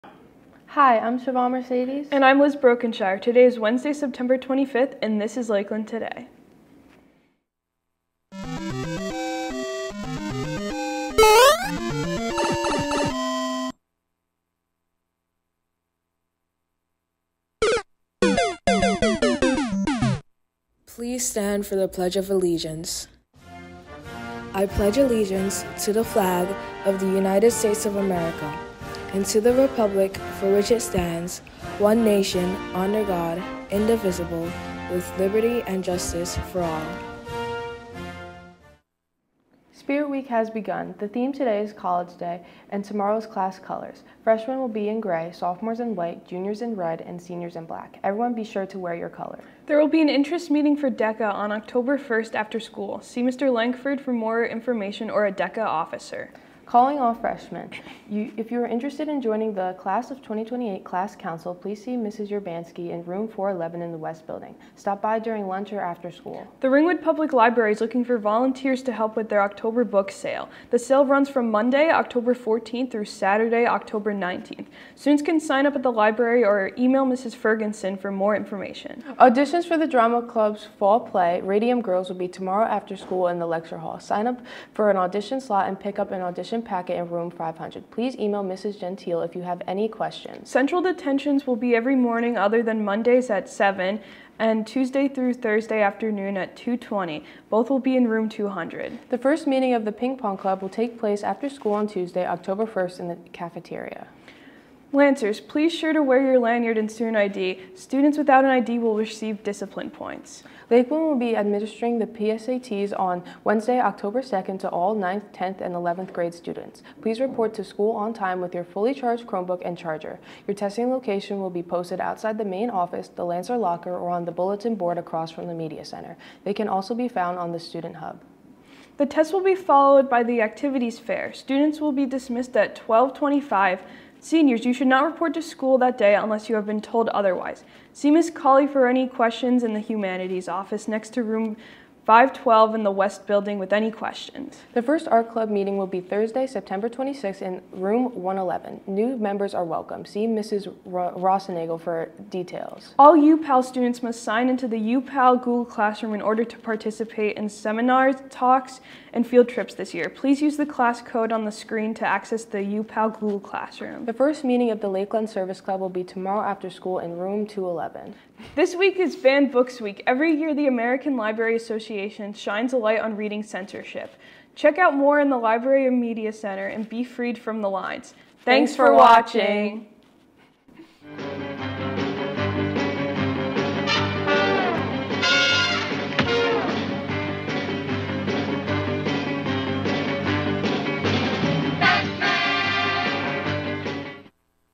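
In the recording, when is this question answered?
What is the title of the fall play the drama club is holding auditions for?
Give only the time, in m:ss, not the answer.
1:21.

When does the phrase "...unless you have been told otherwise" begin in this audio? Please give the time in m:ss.
2:16.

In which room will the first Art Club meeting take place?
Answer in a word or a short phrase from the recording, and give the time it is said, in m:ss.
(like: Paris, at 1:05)
Room 111, at 2:27.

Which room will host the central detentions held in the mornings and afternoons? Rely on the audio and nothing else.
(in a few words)
Room 200.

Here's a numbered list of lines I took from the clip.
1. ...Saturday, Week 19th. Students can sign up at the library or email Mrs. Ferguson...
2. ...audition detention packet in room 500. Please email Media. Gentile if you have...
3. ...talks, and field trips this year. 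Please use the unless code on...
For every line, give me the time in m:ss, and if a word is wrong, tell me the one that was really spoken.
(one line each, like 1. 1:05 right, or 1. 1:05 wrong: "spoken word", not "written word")
1. 1:13 wrong: "October", not "Week"
2. 1:26 wrong: "Mrs", not "Media"
3. 2:38 wrong: "class", not "unless".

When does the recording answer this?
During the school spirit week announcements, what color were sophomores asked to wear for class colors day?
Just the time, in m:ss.
0:45.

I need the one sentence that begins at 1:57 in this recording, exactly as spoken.
Please report to school on time with your fully charged Chromebook and charger.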